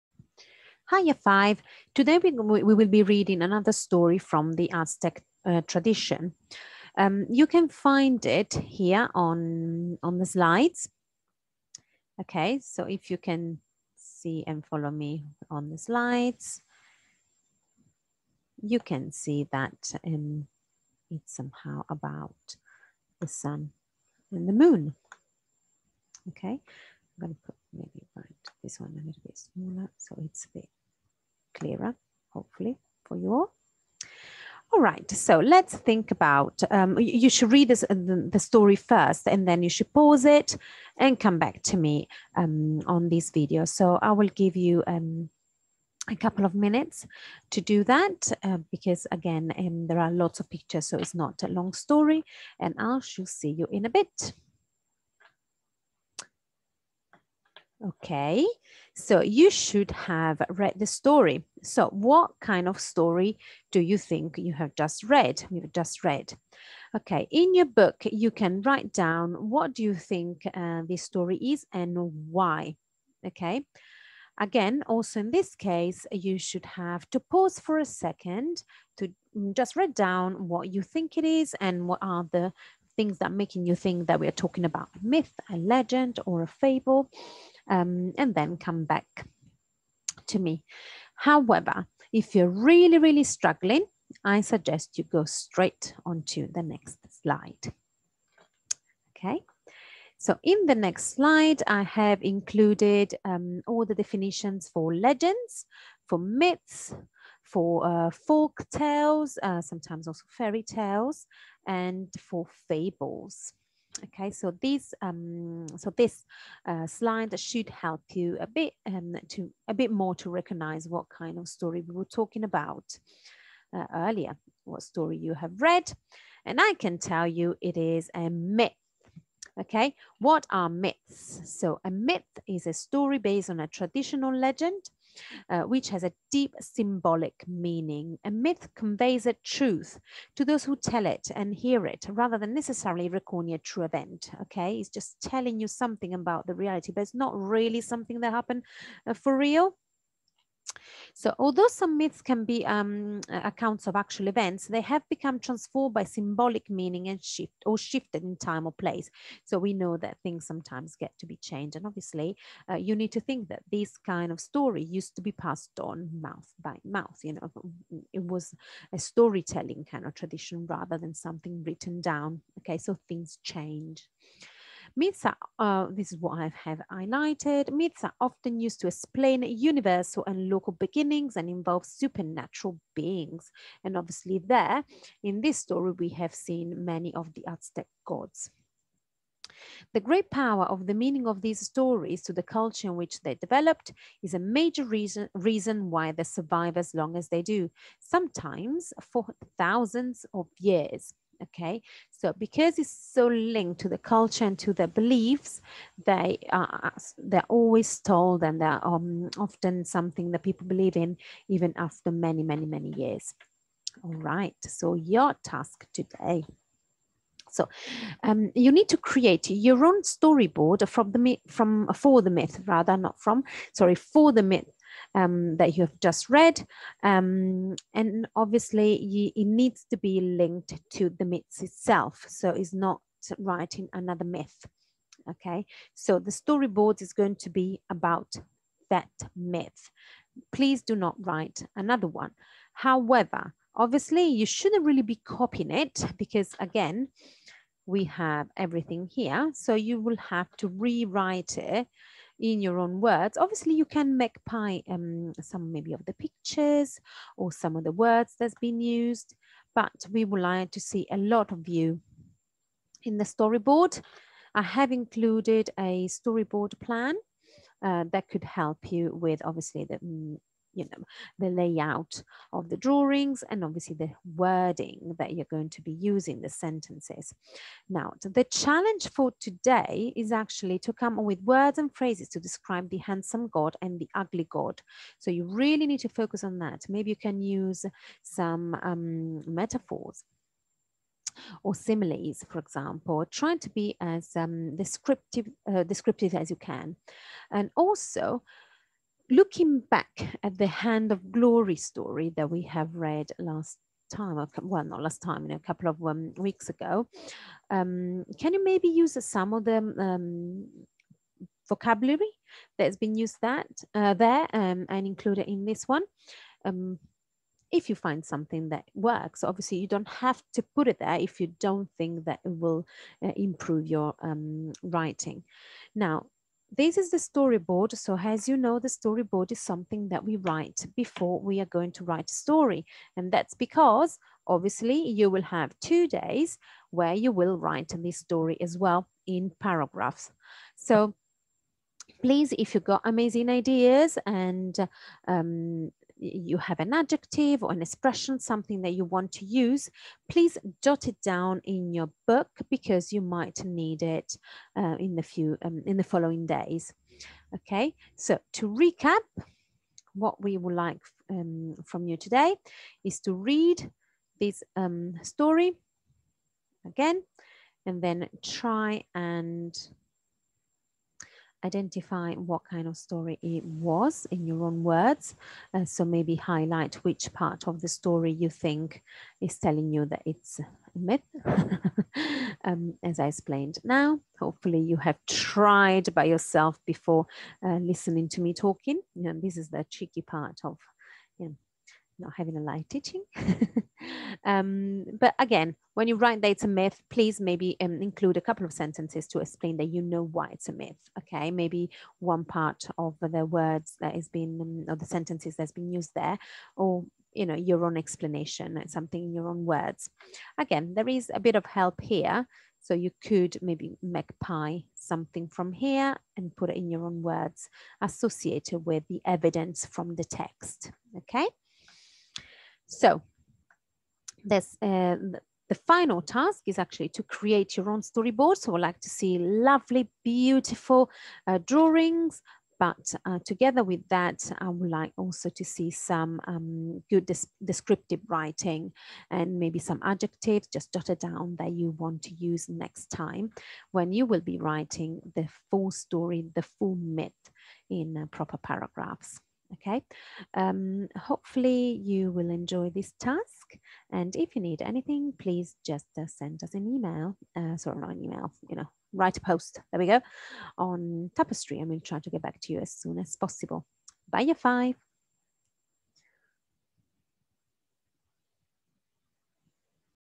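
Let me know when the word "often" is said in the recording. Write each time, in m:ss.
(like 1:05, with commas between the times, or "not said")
2:58, 3:29.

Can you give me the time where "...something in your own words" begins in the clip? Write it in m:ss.
6:48.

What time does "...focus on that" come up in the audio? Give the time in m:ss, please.
4:46.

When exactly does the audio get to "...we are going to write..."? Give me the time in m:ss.
5:31.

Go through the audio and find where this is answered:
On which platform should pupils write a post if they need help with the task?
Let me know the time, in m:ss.
7:41.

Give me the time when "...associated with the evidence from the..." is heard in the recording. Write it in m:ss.
6:58.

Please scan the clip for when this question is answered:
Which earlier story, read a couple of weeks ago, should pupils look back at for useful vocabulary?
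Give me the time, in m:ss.
5:00.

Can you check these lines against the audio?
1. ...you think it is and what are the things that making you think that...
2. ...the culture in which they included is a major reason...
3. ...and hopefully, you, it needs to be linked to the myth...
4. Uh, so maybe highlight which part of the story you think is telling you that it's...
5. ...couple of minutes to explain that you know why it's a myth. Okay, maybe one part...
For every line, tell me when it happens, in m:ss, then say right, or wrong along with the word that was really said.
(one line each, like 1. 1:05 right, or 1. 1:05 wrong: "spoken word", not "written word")
1. 1:20 right
2. 3:12 wrong: "developed", not "included"
3. 3:47 wrong: "obviously", not "hopefully"
4. 6:15 right
5. 6:38 wrong: "sentences", not "minutes".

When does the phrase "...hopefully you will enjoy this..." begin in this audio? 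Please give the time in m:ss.
7:31.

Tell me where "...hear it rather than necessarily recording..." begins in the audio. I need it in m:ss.
2:21.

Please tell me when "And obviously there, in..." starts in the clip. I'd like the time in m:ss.
3:03.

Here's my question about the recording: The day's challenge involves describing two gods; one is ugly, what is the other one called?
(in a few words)
handsome God.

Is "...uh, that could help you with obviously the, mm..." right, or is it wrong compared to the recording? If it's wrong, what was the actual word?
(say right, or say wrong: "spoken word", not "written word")
right.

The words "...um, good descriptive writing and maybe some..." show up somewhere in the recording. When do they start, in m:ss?
7:16.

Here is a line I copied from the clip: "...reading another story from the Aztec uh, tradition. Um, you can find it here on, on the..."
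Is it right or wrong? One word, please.
right.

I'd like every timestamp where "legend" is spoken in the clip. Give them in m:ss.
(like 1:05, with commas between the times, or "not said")
1:25, 1:44, 2:14.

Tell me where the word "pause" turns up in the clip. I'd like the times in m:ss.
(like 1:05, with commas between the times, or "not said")
0:39, 1:17.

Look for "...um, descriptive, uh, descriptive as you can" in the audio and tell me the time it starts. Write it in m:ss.
4:54.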